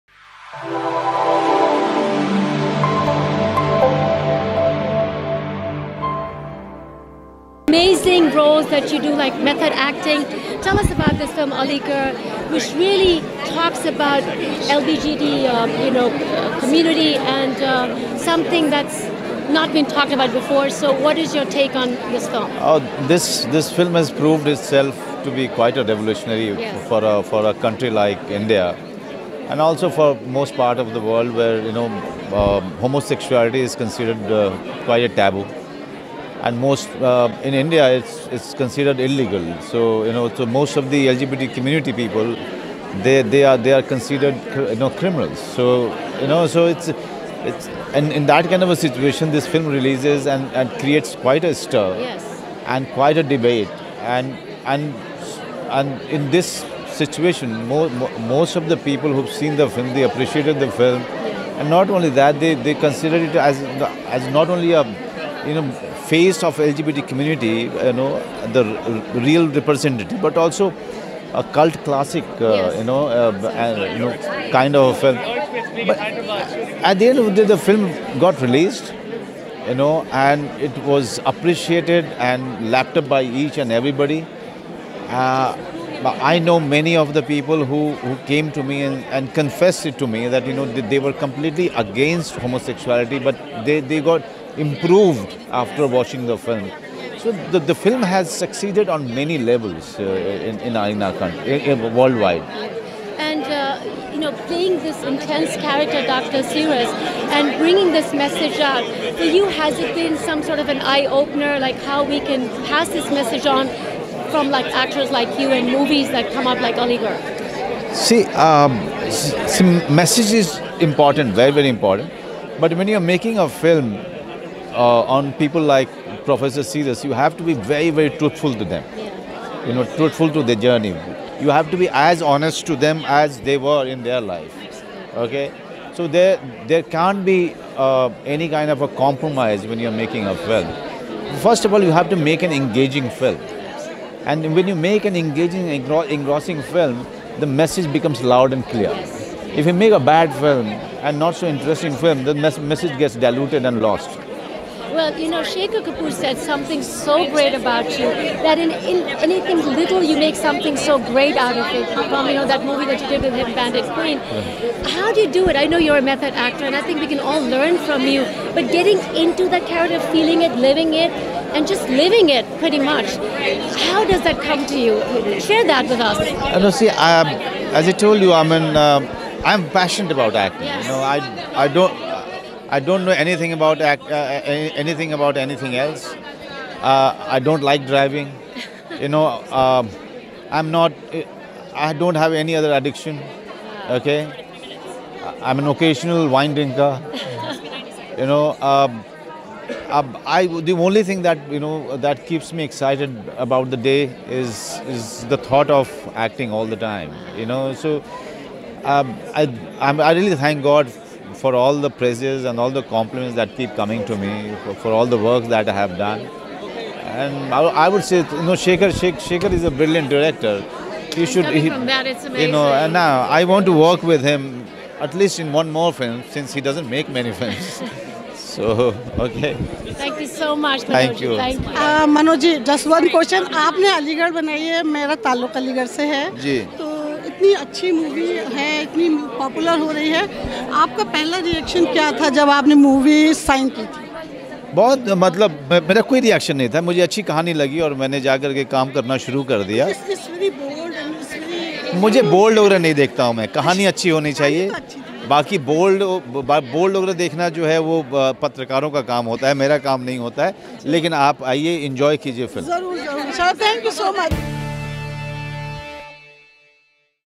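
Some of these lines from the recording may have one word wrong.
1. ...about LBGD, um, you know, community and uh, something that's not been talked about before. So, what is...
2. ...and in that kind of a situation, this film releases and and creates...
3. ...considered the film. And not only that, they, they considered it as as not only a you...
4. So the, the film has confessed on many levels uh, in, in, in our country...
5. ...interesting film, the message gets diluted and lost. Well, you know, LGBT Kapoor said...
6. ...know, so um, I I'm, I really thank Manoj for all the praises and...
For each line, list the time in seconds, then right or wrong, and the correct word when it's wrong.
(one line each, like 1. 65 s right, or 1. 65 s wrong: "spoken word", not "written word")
1. 13 s right
2. 47 s right
3. 60 s wrong: "appreciated", not "considered"
4. 97 s wrong: "succeeded", not "confessed"
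5. 151 s wrong: "Shekhar", not "LGBT"
6. 207 s wrong: "God", not "Manoj".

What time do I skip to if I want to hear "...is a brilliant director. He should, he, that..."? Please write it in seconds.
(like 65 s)
219 s.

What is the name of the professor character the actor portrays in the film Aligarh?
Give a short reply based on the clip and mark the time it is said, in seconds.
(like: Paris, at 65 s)
Dr. Siras, at 106 s.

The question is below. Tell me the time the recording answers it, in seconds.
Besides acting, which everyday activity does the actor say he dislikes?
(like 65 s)
187 s.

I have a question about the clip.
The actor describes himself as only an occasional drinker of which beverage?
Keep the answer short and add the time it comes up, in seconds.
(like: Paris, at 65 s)
Wine, at 196 s.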